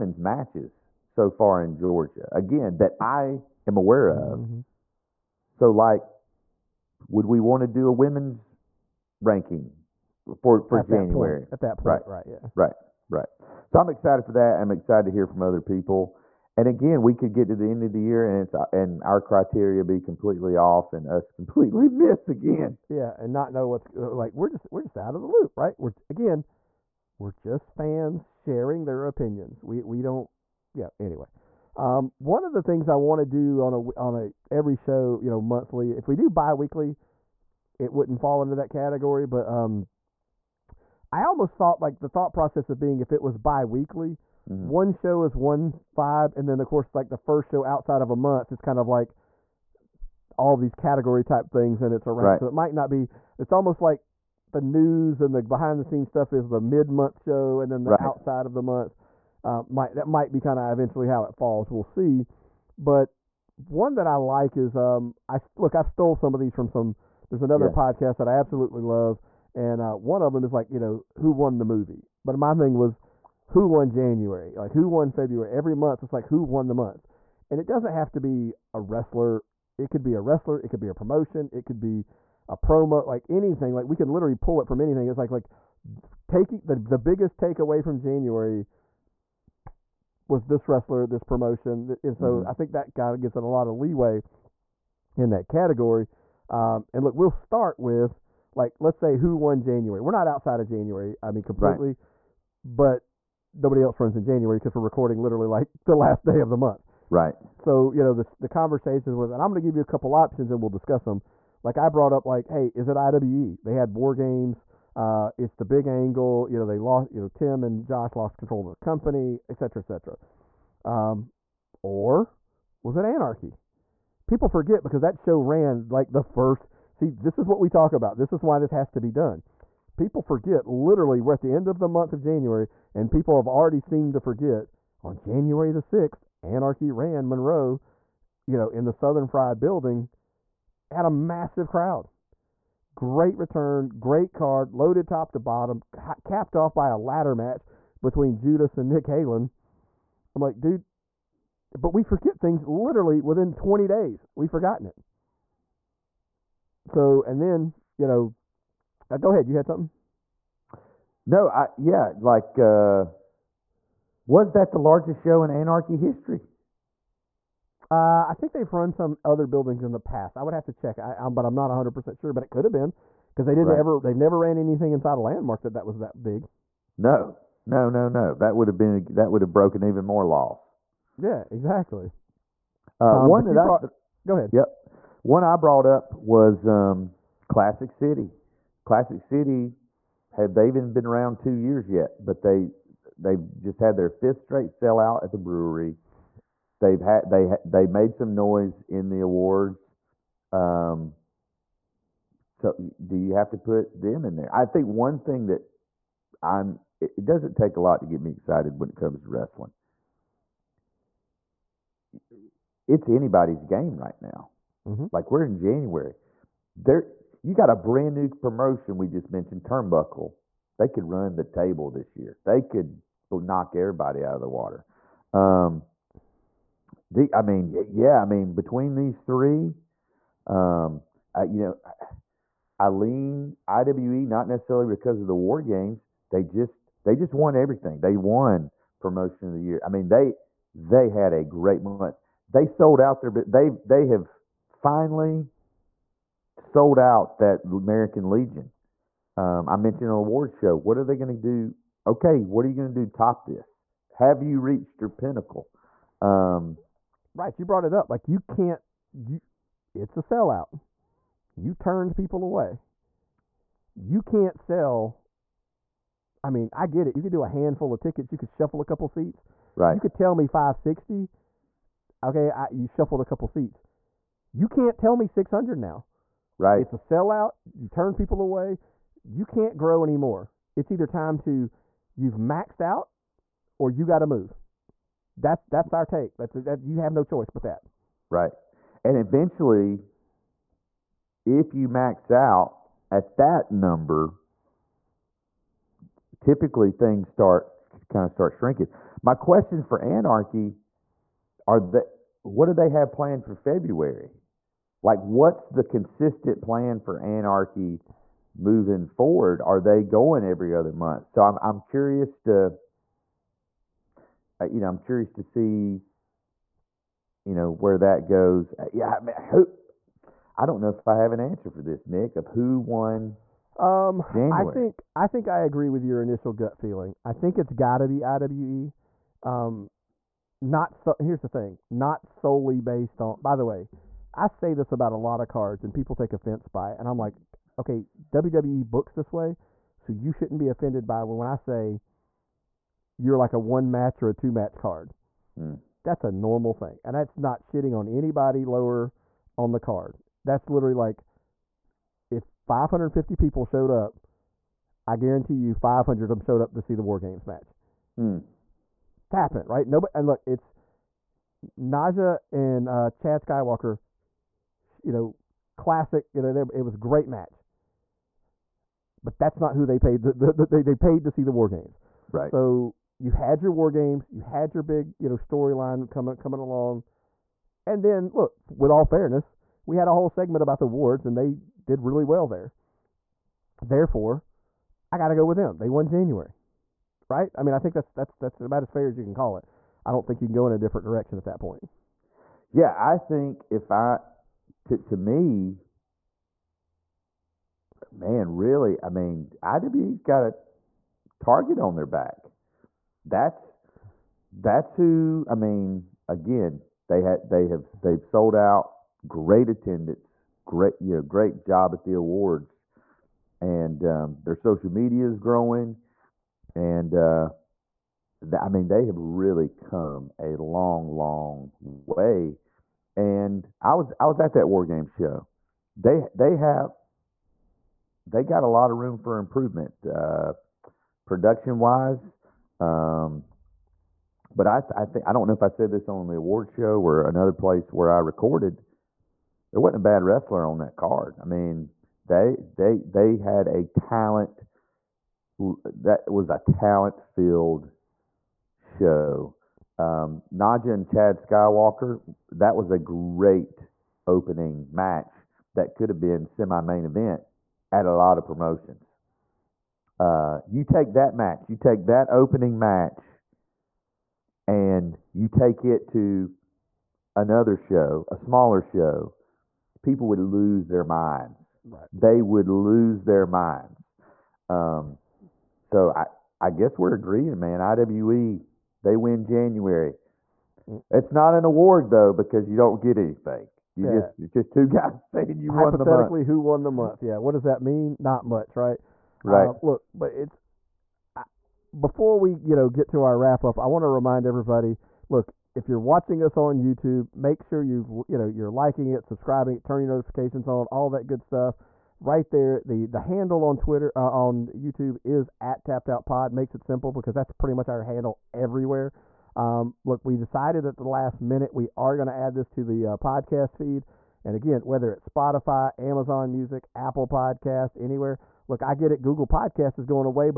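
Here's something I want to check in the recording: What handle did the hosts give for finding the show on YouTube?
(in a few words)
Tapped Out Pod.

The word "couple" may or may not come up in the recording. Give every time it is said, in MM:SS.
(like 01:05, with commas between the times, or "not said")
01:49, 04:28, 04:33.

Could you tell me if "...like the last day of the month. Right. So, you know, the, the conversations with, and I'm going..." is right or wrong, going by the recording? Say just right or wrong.
right.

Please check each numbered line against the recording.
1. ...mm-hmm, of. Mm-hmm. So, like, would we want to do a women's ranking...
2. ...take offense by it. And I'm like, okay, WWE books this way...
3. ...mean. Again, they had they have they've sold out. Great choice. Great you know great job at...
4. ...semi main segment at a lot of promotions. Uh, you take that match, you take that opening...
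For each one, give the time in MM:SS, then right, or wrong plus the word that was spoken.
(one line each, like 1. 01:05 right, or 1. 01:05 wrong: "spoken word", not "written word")
1. 00:04 right
2. 05:36 right
3. 06:45 wrong: "attendance", not "choice"
4. 07:36 wrong: "event", not "segment".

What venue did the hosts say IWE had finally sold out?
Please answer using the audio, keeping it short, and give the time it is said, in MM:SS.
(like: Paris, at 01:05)
American Legion, at 04:07.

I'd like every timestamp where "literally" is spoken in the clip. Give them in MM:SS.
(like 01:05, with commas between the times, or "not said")
01:24, 01:45, 02:10, 02:32, 05:50.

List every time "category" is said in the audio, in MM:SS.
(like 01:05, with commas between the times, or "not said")
00:38, 00:50, 01:35.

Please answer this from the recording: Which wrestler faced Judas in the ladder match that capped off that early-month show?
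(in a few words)
Nick Halen.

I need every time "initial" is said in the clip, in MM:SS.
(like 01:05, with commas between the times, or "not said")
05:26.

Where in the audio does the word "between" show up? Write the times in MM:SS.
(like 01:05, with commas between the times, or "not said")
02:28, 03:48.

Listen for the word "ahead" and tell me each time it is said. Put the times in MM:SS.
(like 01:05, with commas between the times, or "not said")
02:39, 03:04.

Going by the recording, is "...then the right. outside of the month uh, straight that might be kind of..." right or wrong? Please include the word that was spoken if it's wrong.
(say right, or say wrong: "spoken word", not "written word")
wrong: "might", not "straight".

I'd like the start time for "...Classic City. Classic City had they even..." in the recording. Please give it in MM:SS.
03:07.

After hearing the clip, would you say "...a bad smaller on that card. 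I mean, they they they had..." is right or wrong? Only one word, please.
wrong.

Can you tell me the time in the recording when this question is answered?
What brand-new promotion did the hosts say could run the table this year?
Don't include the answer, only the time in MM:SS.
03:39.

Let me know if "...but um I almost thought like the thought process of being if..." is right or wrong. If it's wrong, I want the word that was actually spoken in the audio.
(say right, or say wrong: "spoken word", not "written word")
right.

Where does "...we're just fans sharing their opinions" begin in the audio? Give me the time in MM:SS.
00:27.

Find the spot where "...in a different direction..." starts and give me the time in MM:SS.
06:30.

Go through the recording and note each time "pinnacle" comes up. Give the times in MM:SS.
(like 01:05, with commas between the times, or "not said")
04:15.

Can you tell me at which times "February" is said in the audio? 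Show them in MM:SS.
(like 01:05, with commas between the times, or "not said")
01:15, 05:03.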